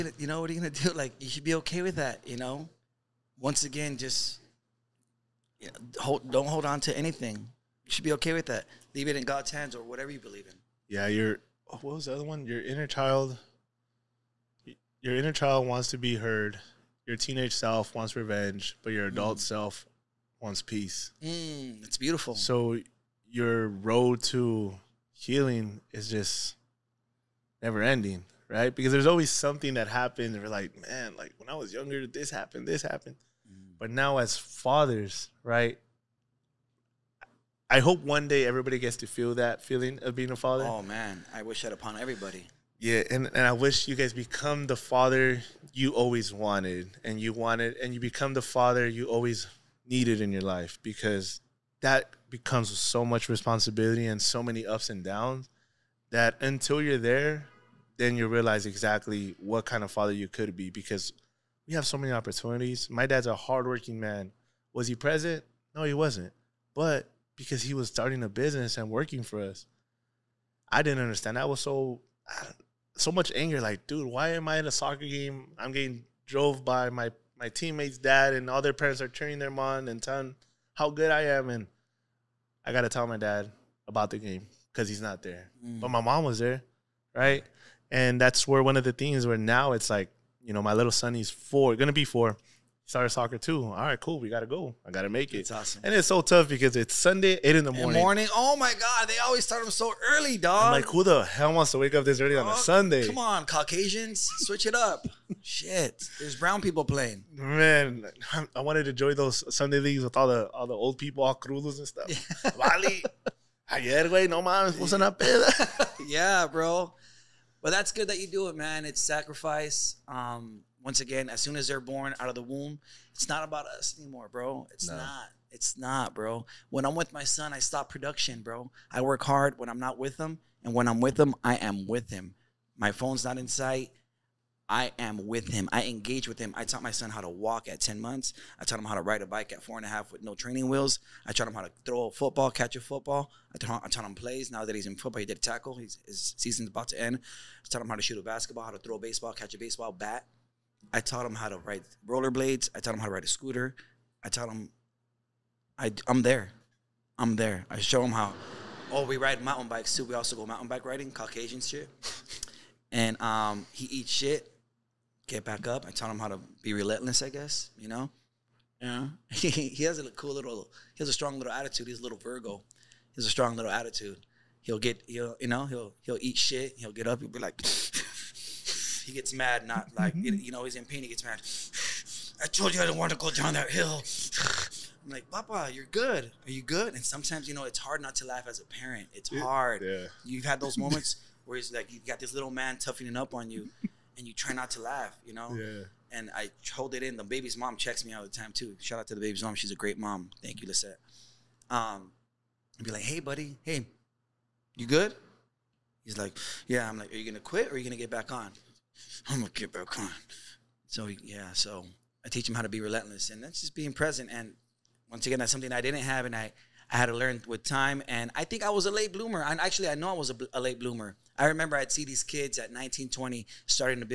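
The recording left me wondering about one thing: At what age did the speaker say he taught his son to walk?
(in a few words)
10 months.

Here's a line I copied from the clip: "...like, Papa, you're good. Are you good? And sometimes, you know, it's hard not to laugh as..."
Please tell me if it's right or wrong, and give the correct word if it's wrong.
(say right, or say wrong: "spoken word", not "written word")
right.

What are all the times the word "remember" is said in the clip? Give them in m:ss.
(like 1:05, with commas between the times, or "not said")
3:41.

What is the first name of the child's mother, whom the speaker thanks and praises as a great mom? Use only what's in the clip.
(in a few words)
Lisette.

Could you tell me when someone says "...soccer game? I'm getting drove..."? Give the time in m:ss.
1:14.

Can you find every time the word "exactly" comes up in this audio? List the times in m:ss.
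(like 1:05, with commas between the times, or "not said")
0:58.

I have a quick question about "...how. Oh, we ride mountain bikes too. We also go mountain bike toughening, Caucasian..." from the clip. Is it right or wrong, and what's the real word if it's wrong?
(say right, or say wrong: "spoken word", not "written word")
wrong: "riding", not "toughening".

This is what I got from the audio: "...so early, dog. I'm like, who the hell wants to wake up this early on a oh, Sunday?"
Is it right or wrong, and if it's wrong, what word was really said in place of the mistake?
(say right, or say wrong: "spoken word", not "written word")
right.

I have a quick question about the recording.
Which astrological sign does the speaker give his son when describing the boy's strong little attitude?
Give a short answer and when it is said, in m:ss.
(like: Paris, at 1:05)
Virgo, at 2:52.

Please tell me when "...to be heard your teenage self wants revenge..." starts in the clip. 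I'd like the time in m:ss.
0:15.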